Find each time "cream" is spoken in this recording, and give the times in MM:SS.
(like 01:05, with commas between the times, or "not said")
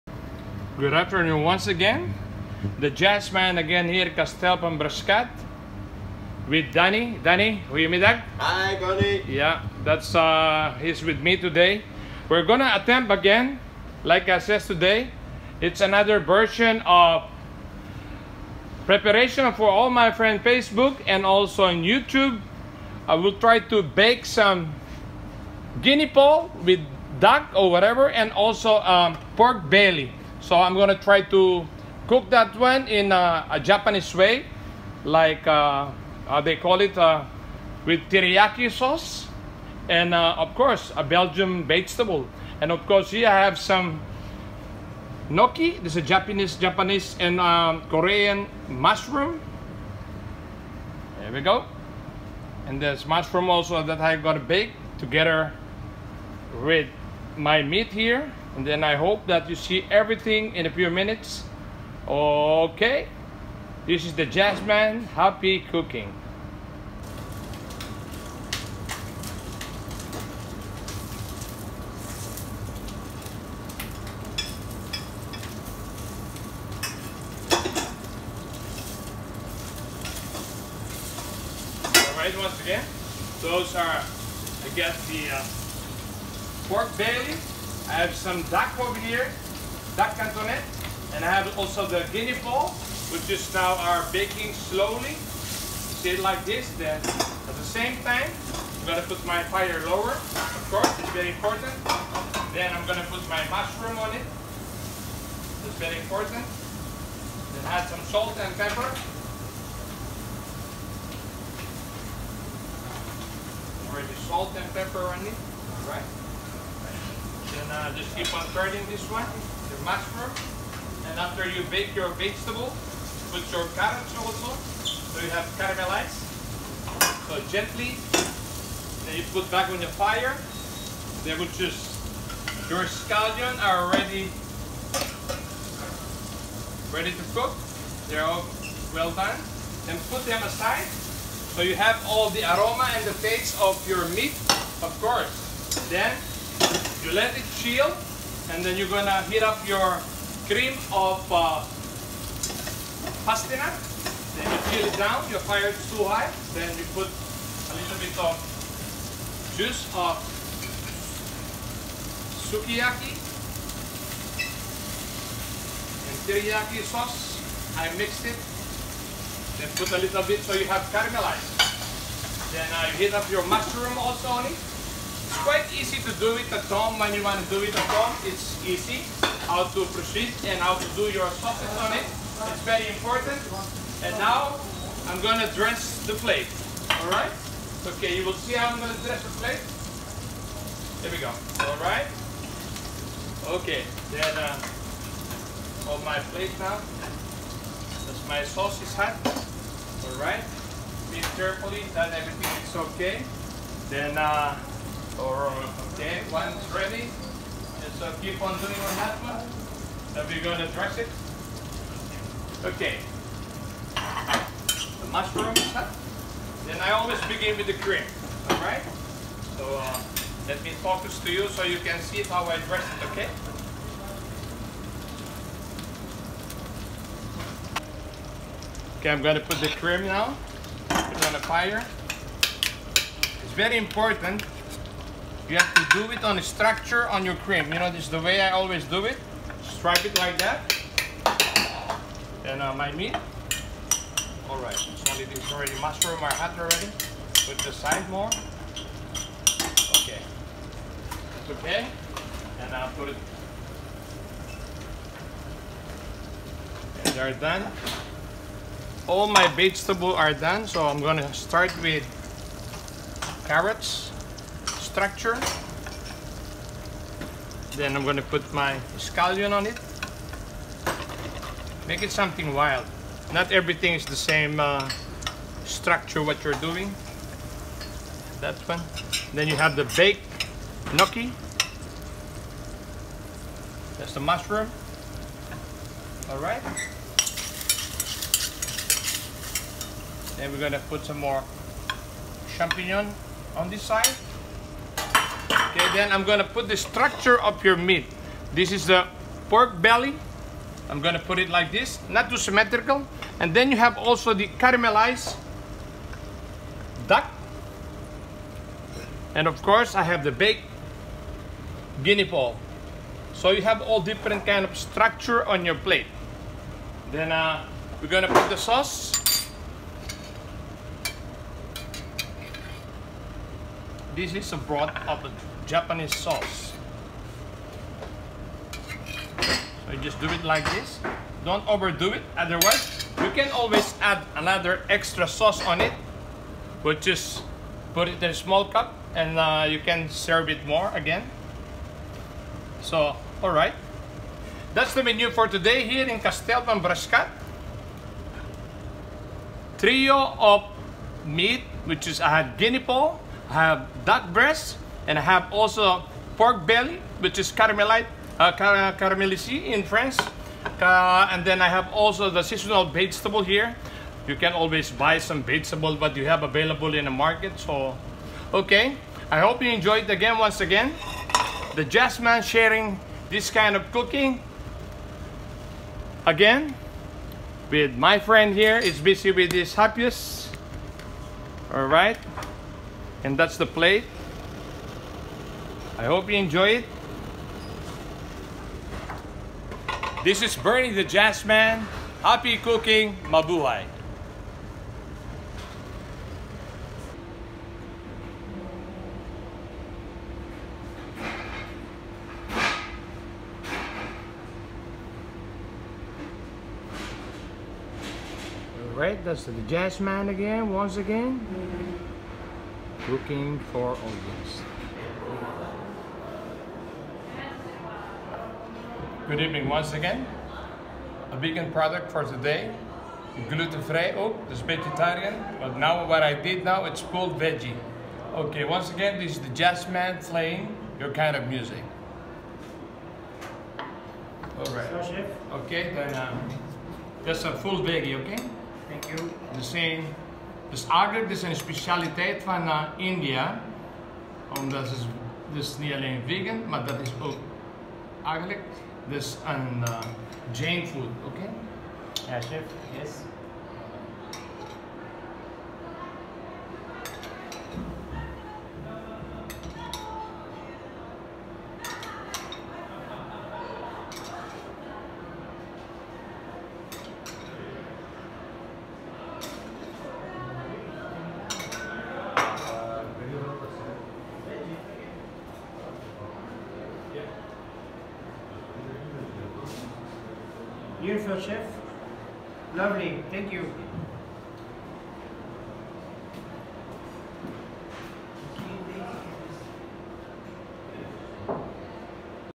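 02:30, 03:37, 03:49, 03:57.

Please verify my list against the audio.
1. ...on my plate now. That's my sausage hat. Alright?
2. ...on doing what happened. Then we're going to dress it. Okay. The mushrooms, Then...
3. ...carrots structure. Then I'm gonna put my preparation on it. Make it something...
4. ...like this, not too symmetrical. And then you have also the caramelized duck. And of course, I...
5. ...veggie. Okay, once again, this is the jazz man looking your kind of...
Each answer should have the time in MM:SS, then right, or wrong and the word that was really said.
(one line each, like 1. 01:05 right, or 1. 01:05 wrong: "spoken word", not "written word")
1. 03:15 right
2. 03:28 right
3. 04:23 wrong: "scallion", not "preparation"
4. 05:01 right
5. 07:07 wrong: "playing", not "looking".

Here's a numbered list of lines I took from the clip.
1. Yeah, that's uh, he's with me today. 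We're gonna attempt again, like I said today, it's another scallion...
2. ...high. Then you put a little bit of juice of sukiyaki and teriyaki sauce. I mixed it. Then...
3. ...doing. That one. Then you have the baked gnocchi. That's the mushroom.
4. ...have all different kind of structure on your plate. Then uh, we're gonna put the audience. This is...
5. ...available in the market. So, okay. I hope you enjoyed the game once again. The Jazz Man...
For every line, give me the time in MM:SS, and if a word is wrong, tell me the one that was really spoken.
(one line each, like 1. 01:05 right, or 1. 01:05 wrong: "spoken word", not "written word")
1. 00:09 wrong: "version", not "scallion"
2. 02:36 right
3. 04:36 right
4. 05:13 wrong: "sauce", not "audience"
5. 06:06 right.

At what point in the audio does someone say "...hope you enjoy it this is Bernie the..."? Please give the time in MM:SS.
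06:26.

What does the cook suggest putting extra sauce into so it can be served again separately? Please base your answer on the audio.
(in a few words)
A small cup.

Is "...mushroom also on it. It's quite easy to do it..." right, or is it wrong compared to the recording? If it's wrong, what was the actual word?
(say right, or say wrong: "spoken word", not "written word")
right.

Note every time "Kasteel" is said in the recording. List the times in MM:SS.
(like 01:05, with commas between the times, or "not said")
00:04, 05:46.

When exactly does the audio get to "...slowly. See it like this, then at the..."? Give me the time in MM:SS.
01:34.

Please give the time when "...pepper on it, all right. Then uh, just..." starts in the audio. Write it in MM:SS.
01:54.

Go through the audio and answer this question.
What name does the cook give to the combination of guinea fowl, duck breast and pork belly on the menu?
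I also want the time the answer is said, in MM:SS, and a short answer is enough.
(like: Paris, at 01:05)
Trio of meat, at 05:49.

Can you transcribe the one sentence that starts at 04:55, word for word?
Okay, then I'm gonna put the structure of your meat.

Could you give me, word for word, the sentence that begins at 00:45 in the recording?
This is Japanese, Japanese and um, Korean mushroom.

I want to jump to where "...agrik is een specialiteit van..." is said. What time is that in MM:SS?
07:20.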